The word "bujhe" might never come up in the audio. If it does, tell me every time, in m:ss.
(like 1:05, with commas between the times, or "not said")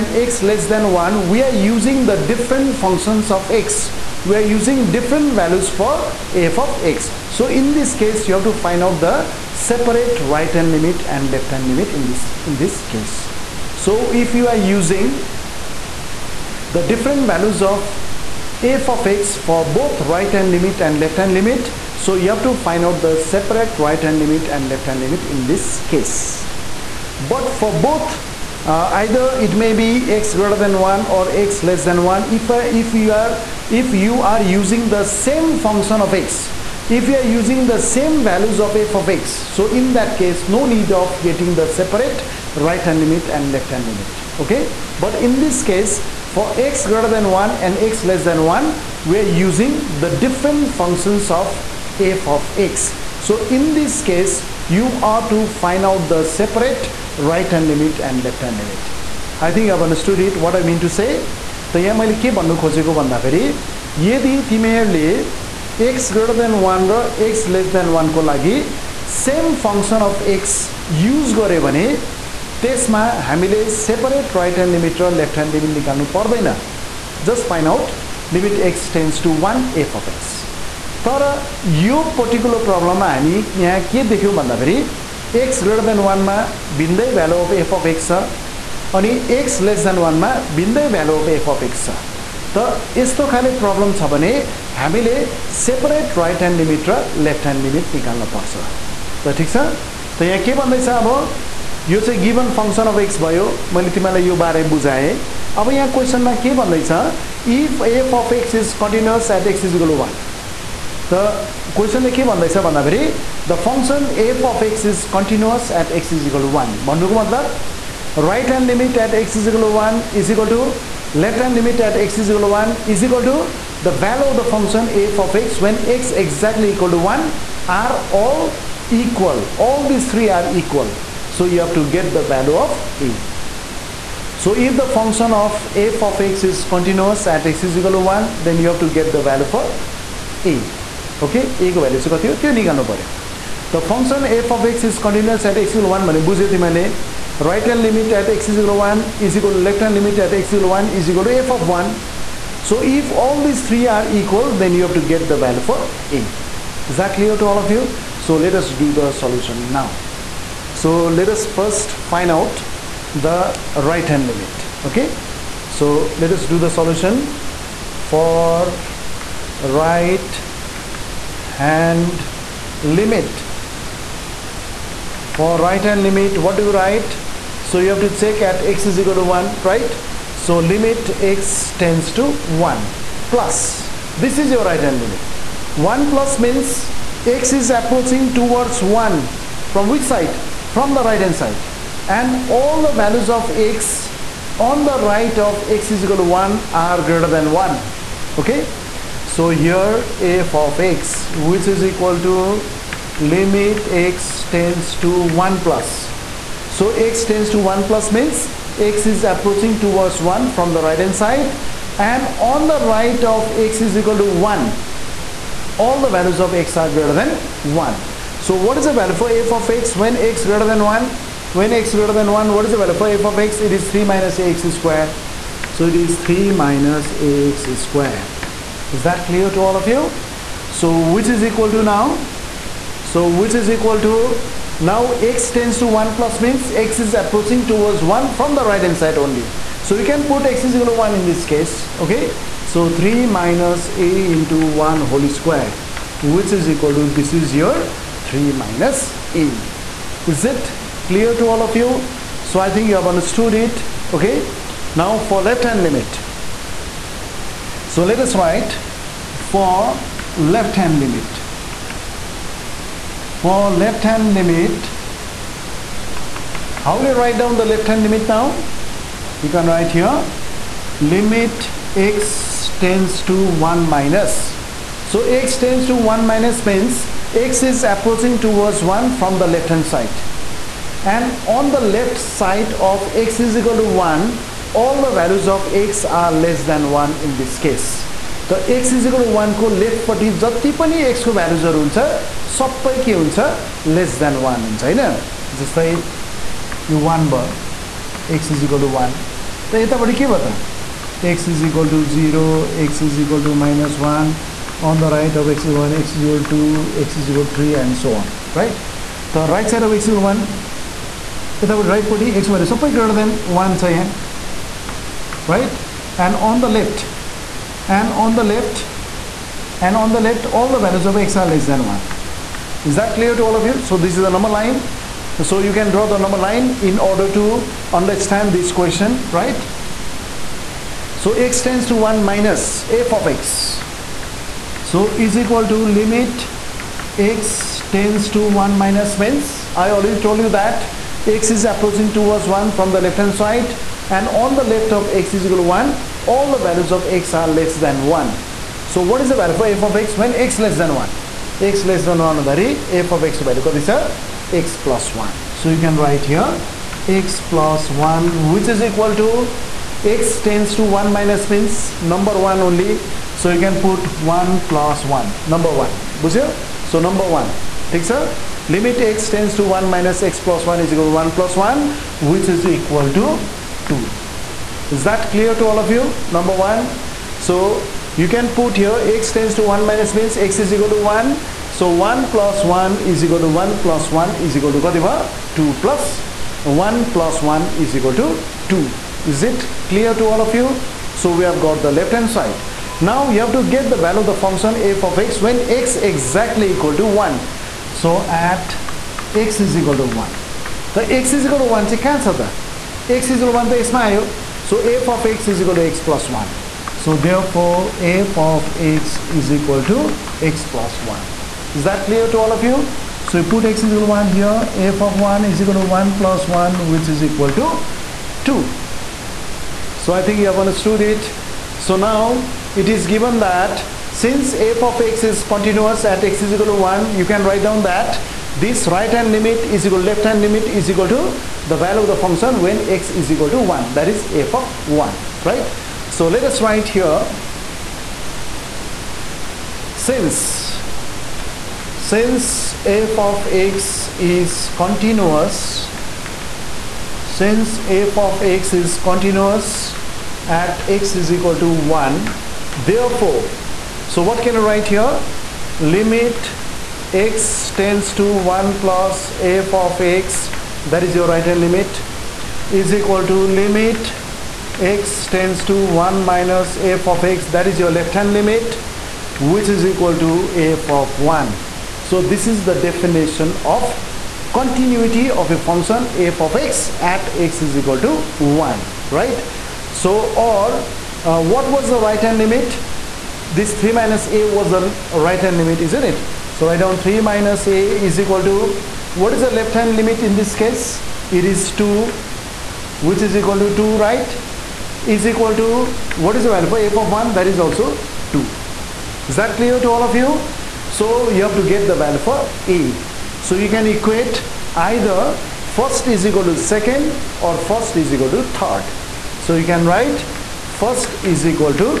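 2:26.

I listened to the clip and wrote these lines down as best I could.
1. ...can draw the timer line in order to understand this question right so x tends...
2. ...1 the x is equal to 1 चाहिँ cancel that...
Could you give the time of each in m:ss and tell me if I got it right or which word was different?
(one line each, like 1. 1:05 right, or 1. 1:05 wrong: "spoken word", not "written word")
1. 5:25 wrong: "number", not "timer"
2. 6:40 right.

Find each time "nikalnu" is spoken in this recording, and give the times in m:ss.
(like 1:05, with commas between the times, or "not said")
1:15, 2:22.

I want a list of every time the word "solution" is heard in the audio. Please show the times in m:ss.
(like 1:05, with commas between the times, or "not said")
2:39, 2:46.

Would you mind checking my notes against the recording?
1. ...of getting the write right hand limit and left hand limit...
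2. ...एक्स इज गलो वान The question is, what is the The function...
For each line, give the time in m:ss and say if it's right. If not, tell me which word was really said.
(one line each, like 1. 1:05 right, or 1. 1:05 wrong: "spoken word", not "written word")
1. 0:40 wrong: "separate", not "write"
2. 1:49 right.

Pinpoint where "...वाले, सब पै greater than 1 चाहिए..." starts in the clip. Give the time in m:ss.
5:12.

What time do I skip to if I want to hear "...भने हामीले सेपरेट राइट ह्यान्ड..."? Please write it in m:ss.
1:34.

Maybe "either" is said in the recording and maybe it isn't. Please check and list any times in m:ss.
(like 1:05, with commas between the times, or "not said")
0:29, 8:24.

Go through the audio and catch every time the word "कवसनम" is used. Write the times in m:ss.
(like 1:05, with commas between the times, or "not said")
1:45.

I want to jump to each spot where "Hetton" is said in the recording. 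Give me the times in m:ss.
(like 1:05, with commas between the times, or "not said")
not said.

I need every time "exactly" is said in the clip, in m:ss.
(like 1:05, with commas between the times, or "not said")
2:06, 6:35.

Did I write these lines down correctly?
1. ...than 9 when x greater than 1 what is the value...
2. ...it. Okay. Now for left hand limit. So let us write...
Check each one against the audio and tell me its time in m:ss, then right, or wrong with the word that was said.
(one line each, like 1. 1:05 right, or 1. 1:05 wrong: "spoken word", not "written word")
1. 3:40 wrong: "1", not "9"
2. 4:13 right.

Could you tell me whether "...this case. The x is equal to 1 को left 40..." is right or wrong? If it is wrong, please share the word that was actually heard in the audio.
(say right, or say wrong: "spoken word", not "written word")
right.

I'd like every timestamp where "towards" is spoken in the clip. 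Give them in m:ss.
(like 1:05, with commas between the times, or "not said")
3:08, 3:29, 3:57, 4:38, 5:42.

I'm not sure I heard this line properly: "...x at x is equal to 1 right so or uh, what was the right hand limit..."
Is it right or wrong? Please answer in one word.
right.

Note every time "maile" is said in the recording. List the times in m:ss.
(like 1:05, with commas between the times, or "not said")
1:01, 2:26.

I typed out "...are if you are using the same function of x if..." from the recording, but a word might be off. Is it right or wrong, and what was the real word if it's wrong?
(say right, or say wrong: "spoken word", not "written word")
right.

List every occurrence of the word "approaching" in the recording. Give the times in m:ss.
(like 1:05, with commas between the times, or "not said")
3:07, 3:29, 3:57, 4:37, 5:41.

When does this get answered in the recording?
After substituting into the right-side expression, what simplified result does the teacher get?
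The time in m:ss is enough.
4:07.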